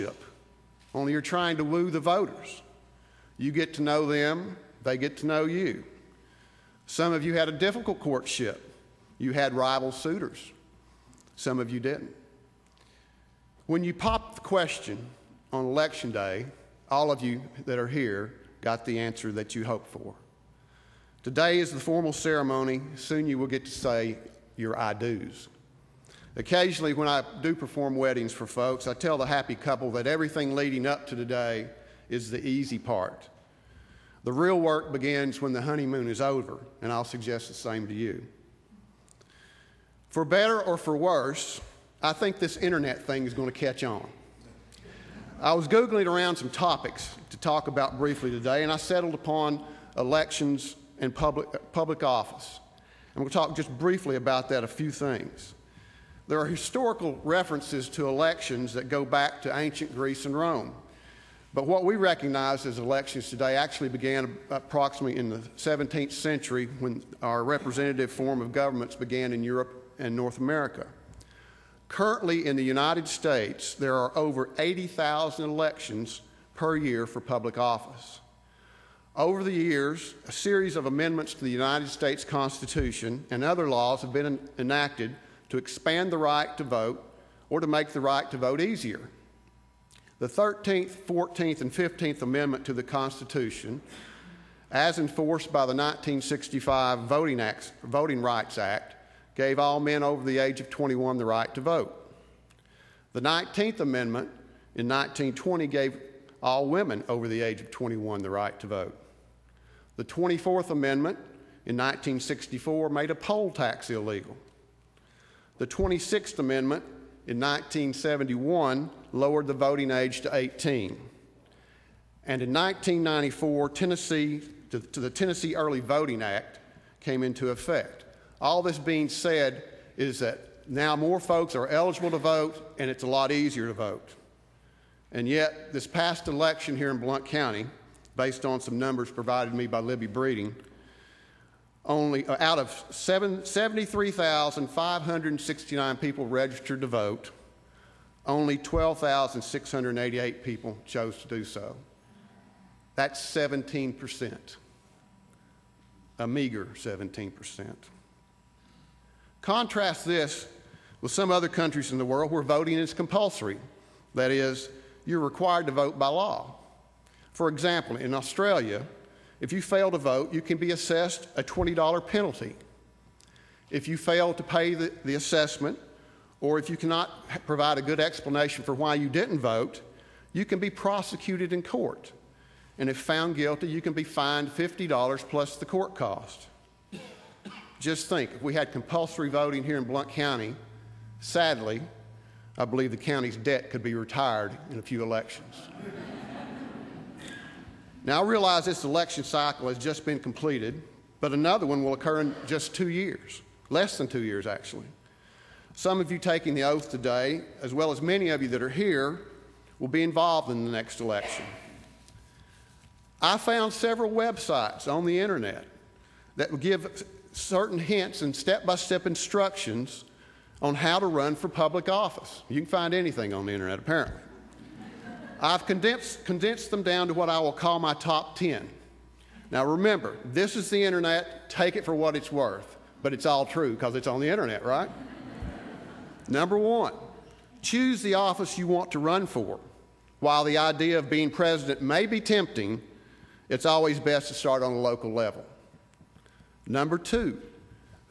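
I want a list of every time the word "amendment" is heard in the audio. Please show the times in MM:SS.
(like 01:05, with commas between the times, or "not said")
01:20, 01:32, 01:43, 01:50, 01:56.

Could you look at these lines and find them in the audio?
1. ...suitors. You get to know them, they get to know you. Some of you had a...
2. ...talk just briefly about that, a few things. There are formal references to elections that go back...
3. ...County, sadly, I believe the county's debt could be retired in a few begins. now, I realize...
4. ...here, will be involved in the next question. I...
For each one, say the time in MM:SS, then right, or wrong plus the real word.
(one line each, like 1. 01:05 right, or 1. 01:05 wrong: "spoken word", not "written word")
1. 00:01 wrong: "voters", not "suitors"
2. 00:53 wrong: "historical", not "formal"
3. 03:10 wrong: "elections", not "begins"
4. 03:28 wrong: "election", not "question".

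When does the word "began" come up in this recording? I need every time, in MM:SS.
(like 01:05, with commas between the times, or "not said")
01:03, 01:08.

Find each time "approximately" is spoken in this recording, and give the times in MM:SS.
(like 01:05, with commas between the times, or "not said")
01:04.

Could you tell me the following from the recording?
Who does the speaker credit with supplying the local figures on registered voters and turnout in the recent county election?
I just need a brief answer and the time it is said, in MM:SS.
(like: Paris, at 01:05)
Libby Breeding, at 02:19.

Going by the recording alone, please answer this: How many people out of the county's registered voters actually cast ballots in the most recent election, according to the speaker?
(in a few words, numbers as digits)
12,688.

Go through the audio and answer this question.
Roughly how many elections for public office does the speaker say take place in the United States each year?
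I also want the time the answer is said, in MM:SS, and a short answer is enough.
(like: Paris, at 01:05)
80,000, at 01:14.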